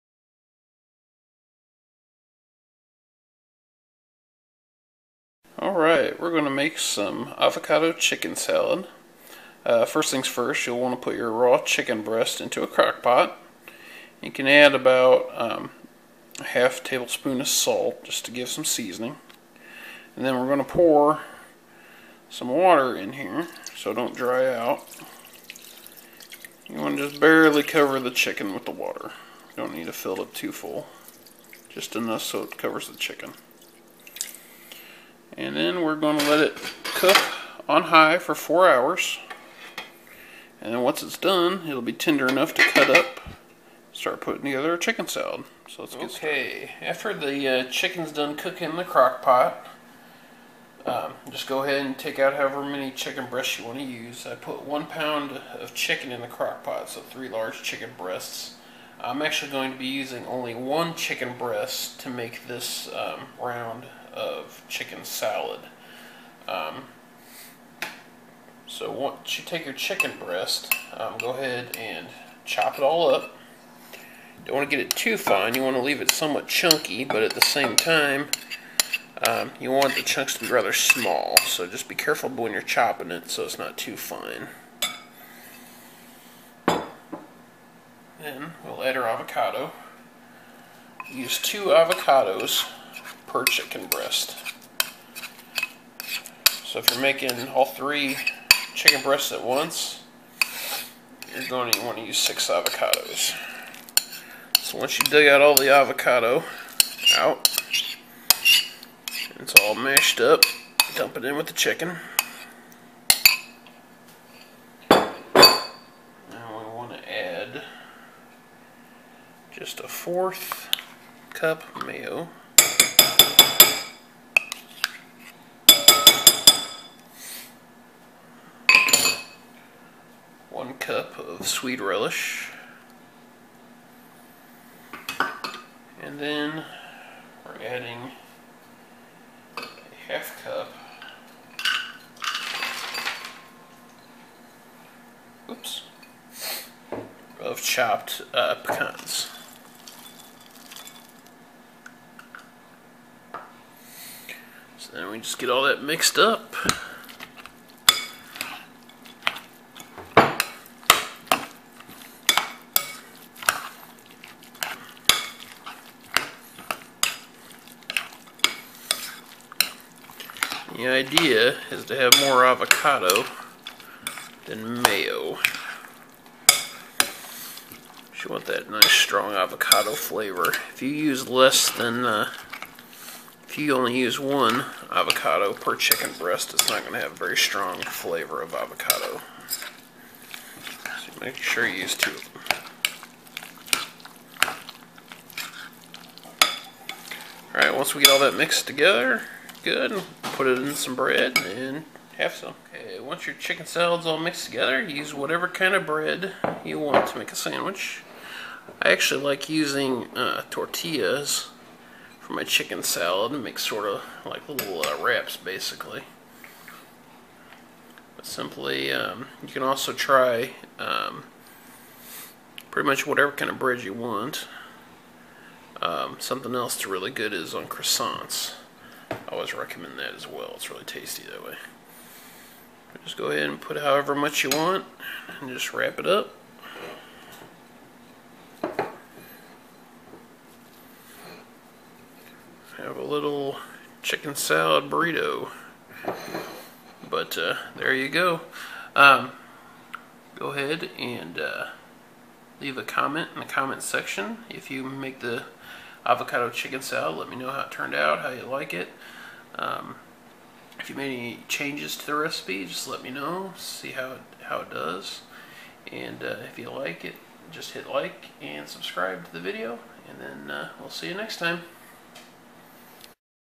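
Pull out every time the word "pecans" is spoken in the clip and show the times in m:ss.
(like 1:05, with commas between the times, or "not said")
2:28.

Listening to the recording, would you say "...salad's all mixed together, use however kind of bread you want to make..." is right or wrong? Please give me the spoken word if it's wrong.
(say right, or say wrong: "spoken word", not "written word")
wrong: "whatever", not "however".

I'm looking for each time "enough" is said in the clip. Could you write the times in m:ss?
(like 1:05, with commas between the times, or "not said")
0:31, 0:42.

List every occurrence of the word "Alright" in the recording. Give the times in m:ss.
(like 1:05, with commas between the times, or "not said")
0:05, 3:17.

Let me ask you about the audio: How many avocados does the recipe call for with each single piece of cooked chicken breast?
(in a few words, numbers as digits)
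2.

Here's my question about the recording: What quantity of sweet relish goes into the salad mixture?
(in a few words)
1 cup.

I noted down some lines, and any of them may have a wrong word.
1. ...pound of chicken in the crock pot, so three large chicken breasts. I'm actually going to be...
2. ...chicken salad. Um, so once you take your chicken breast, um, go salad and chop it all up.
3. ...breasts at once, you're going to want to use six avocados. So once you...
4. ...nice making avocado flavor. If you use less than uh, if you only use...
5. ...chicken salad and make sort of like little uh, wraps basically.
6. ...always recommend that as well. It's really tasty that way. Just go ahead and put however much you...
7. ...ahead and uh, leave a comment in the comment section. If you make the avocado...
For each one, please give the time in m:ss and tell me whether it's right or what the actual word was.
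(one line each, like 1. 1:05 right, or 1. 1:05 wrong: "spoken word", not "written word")
1. 0:54 right
2. 1:04 wrong: "ahead", not "salad"
3. 1:39 right
4. 2:58 wrong: "strong", not "making"
5. 3:32 right
6. 3:49 right
7. 4:10 right.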